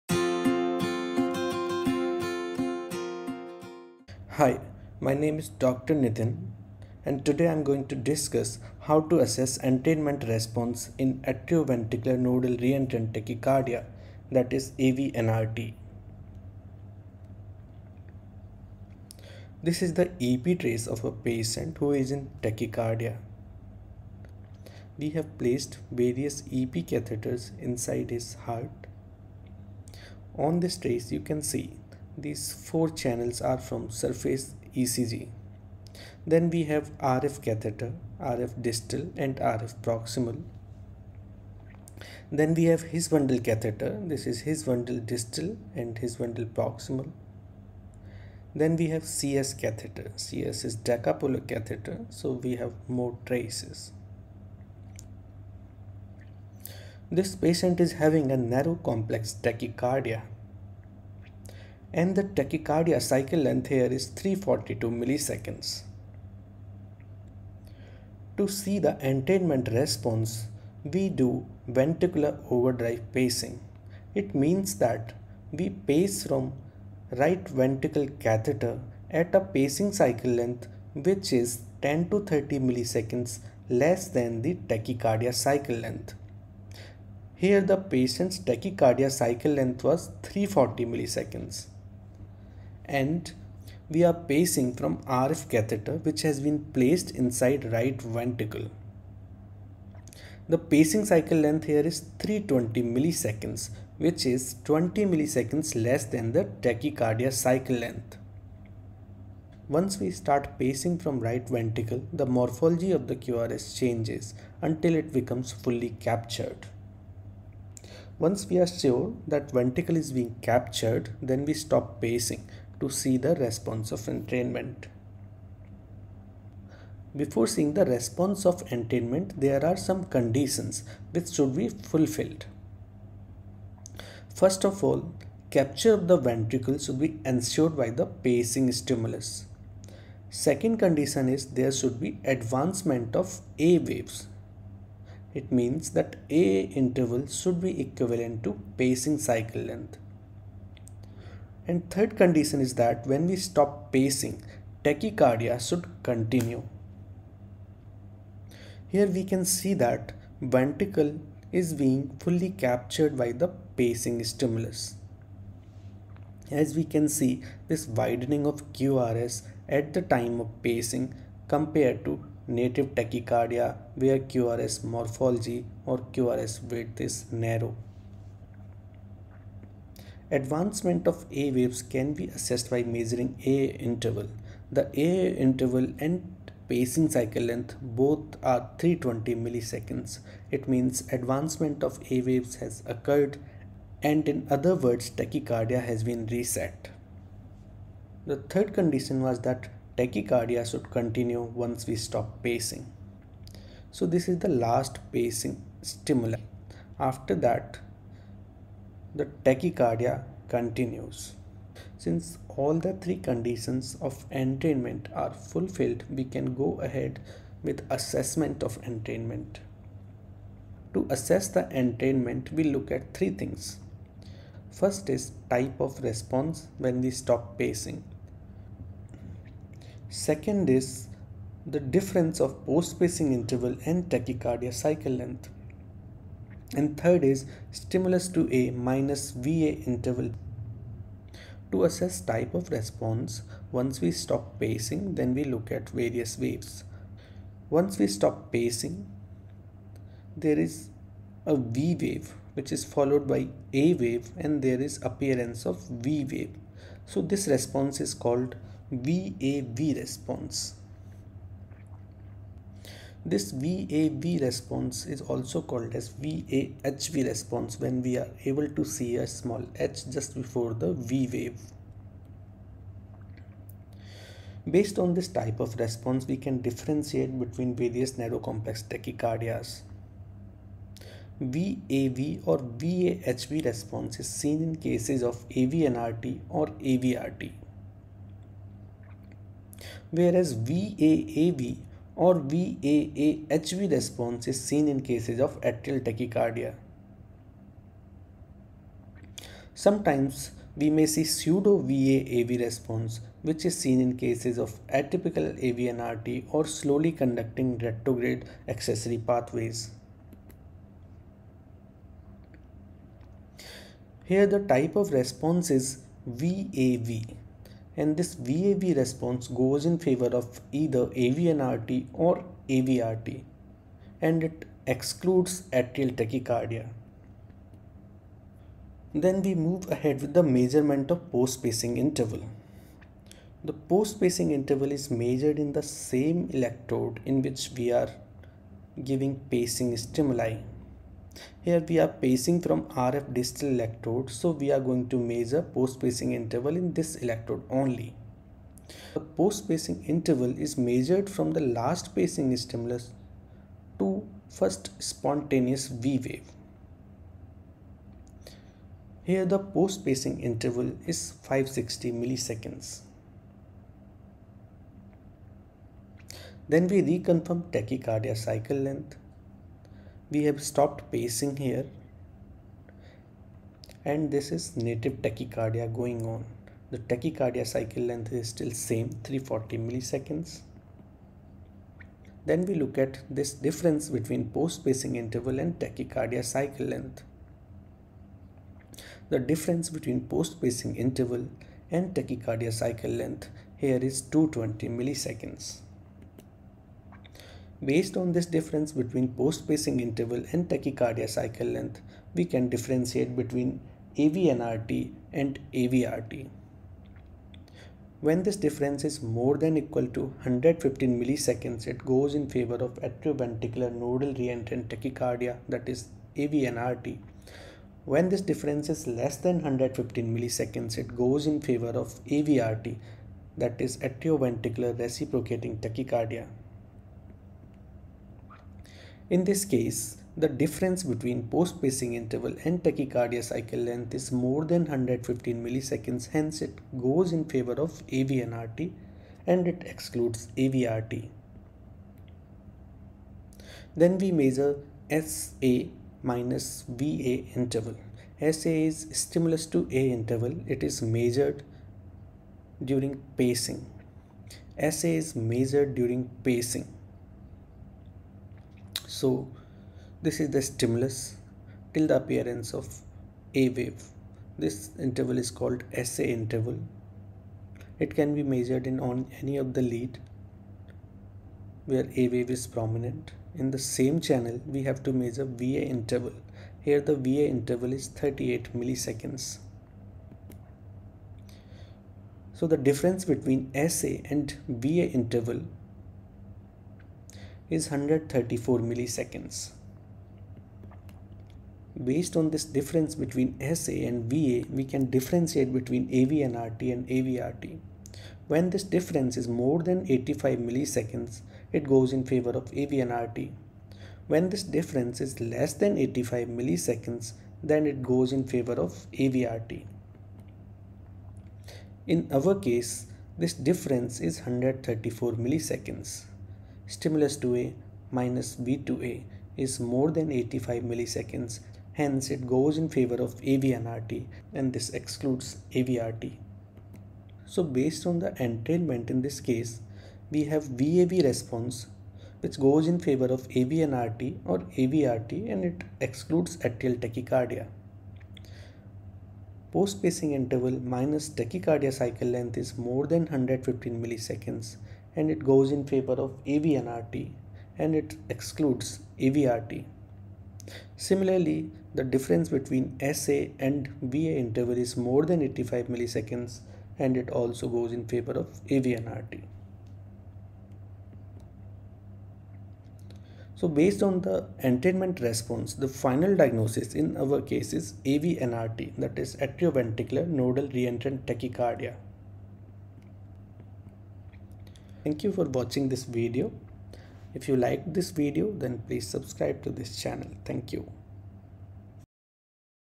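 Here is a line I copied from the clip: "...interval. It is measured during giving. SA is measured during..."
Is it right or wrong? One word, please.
wrong.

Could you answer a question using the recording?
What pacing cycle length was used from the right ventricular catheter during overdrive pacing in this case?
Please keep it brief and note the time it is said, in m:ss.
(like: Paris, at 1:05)
320 milliseconds, at 1:40.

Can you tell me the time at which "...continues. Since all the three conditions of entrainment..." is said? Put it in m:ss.
3:30.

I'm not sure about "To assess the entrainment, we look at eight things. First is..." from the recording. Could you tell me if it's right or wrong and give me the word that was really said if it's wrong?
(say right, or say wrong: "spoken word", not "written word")
wrong: "three", not "eight".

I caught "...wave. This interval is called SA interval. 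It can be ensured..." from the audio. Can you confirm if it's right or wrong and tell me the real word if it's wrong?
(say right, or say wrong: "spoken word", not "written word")
wrong: "measured", not "ensured".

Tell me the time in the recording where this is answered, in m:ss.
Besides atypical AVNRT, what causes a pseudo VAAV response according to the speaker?
5:06.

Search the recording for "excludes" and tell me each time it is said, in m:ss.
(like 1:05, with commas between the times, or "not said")
5:24, 7:19, 8:44, 8:56, 9:08.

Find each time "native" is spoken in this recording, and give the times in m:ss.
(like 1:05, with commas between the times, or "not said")
2:52, 6:14.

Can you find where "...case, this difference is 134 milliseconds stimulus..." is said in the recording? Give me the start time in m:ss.
8:32.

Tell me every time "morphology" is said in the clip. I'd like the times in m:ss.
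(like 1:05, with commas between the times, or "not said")
1:52, 2:54.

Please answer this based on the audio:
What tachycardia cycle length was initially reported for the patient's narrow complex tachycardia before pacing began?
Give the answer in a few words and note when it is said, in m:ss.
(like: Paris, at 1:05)
342 milliseconds, at 1:04.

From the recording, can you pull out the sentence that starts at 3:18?
The third condition was that tachycardia should continue once we stop pacing.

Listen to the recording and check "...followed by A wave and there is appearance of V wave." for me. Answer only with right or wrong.
right.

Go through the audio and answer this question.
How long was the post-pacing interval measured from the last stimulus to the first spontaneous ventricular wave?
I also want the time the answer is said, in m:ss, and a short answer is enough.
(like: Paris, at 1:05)
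560 milliseconds, at 6:01.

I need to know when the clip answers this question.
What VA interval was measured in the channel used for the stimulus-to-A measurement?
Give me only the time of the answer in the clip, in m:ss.
7:58.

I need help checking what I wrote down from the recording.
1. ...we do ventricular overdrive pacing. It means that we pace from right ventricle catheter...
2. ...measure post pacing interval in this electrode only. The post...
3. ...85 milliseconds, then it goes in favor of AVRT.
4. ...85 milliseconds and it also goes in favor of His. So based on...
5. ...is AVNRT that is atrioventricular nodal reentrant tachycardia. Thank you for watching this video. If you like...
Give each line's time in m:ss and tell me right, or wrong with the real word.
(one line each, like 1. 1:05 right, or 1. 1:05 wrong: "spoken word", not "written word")
1. 1:10 right
2. 5:45 right
3. 8:25 right
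4. 9:15 wrong: "AVNRT", not "His"
5. 9:27 right.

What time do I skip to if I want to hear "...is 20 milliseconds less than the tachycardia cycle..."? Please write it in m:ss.
1:44.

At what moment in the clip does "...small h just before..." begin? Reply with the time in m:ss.
4:29.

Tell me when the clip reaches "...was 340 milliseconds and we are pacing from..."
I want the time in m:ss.
1:29.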